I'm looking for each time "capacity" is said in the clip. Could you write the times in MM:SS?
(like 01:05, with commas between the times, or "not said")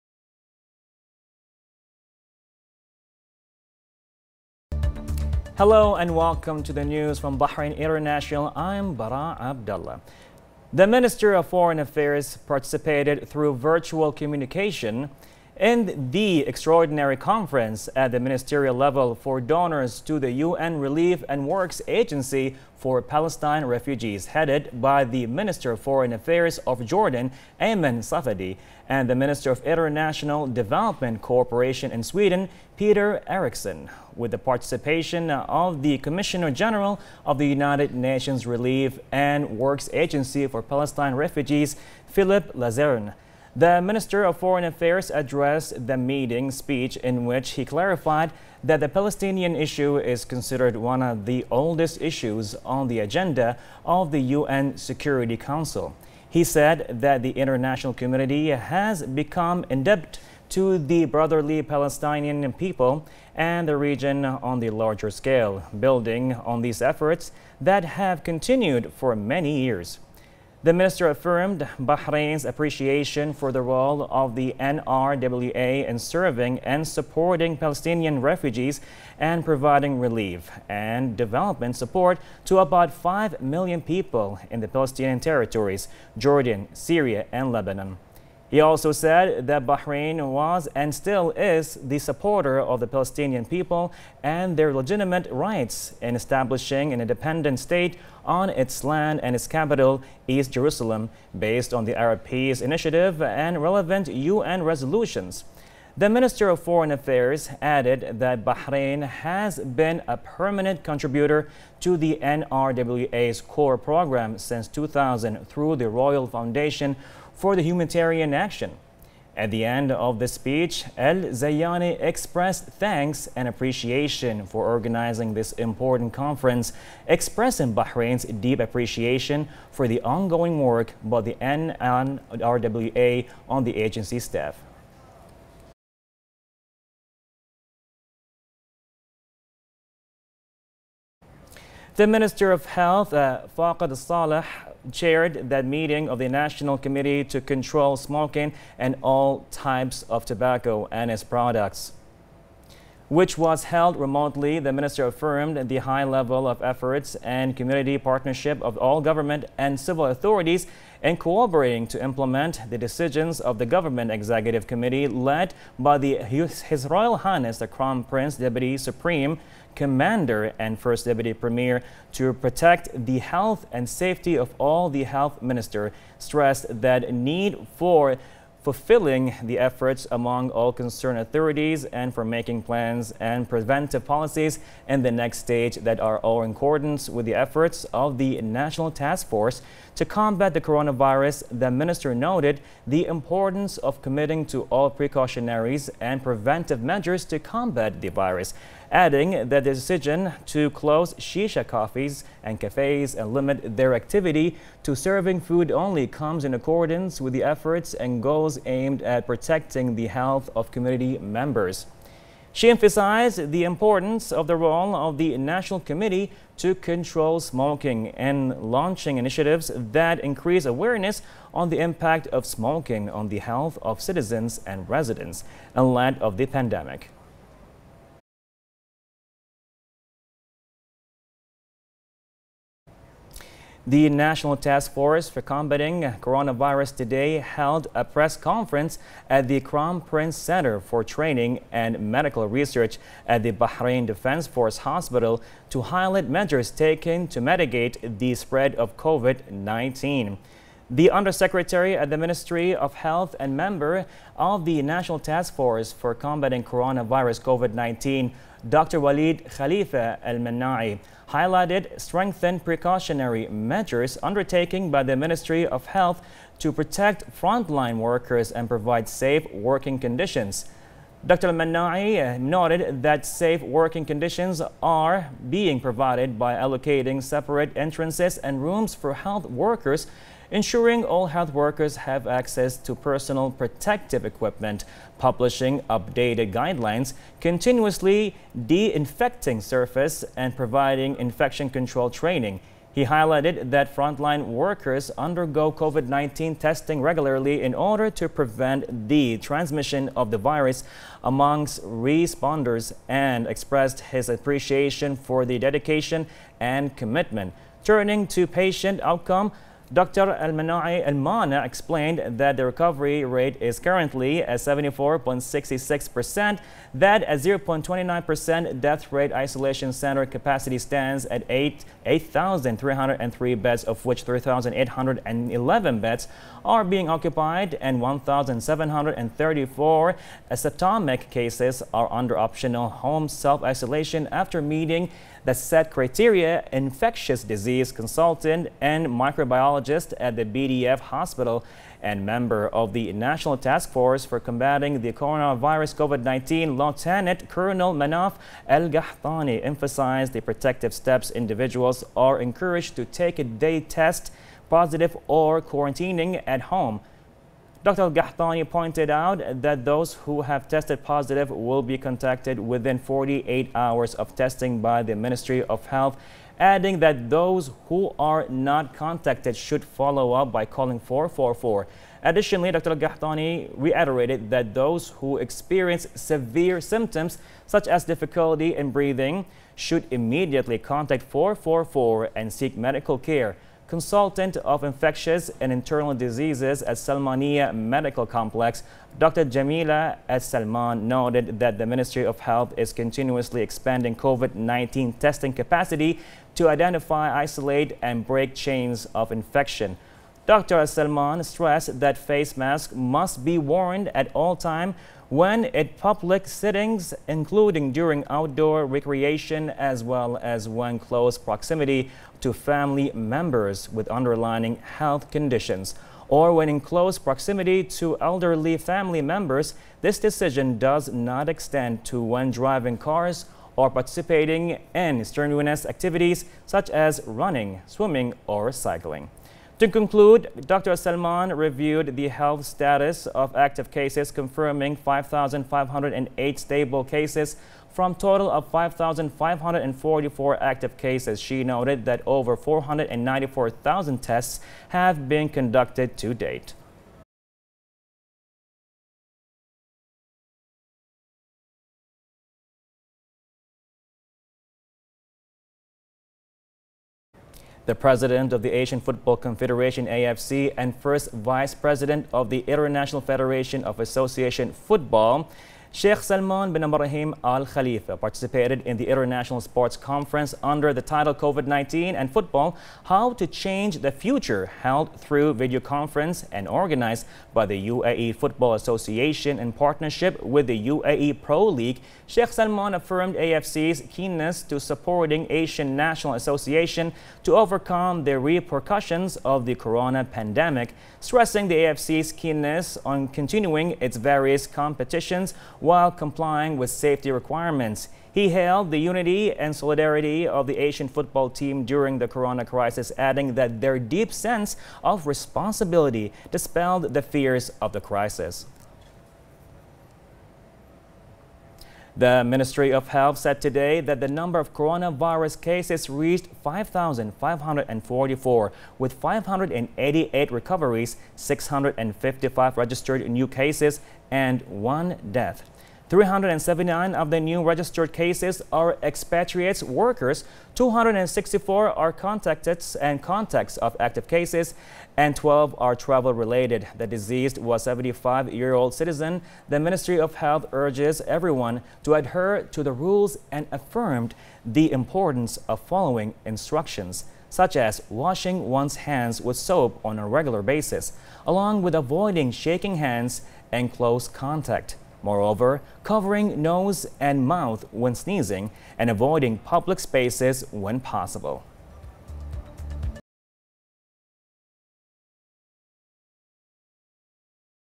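05:20, 06:35.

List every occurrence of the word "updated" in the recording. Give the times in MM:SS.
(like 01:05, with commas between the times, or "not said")
04:45.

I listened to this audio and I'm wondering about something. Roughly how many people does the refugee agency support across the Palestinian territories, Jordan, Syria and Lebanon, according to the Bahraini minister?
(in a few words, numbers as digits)
5 million.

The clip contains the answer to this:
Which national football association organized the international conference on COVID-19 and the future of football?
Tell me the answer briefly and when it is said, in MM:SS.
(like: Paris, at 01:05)
UAE Football Association, at 07:57.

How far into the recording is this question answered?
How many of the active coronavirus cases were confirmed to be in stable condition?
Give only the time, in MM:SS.
07:14.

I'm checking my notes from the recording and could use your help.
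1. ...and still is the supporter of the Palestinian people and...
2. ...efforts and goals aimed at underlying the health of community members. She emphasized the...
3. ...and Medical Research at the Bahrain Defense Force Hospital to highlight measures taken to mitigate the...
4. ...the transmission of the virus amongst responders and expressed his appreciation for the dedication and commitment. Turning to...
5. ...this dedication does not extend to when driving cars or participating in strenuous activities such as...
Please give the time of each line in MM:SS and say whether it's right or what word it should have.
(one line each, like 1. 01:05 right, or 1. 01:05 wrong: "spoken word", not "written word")
1. 01:30 right
2. 03:27 wrong: "protecting", not "underlying"
3. 04:01 right
4. 04:59 right
5. 07:00 wrong: "decision", not "dedication".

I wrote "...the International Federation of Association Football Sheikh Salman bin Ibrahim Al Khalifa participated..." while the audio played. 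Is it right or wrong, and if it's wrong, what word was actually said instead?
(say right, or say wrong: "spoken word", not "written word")
right.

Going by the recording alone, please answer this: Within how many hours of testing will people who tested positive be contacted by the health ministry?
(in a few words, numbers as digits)
48 hours.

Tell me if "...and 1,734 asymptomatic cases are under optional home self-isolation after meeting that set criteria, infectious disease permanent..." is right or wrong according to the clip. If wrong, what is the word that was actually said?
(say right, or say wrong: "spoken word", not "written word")
wrong: "consultant", not "permanent".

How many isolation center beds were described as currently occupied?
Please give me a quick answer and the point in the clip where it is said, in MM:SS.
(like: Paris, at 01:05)
3,811, at 05:24.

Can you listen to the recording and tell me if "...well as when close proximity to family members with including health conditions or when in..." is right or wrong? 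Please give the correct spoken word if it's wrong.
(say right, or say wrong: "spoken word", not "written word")
wrong: "underlying", not "including".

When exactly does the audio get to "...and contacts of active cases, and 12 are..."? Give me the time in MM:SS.
08:52.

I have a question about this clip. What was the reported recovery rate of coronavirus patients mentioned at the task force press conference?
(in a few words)
74.66%.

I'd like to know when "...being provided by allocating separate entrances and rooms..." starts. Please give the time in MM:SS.
04:35.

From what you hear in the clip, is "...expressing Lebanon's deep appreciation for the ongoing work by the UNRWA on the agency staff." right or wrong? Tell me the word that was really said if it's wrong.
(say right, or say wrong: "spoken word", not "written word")
wrong: "Bahrain", not "Lebanon".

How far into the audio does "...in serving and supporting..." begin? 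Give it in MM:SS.
01:15.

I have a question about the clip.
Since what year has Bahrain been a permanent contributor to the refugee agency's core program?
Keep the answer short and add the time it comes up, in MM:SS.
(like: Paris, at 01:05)
2000, at 01:54.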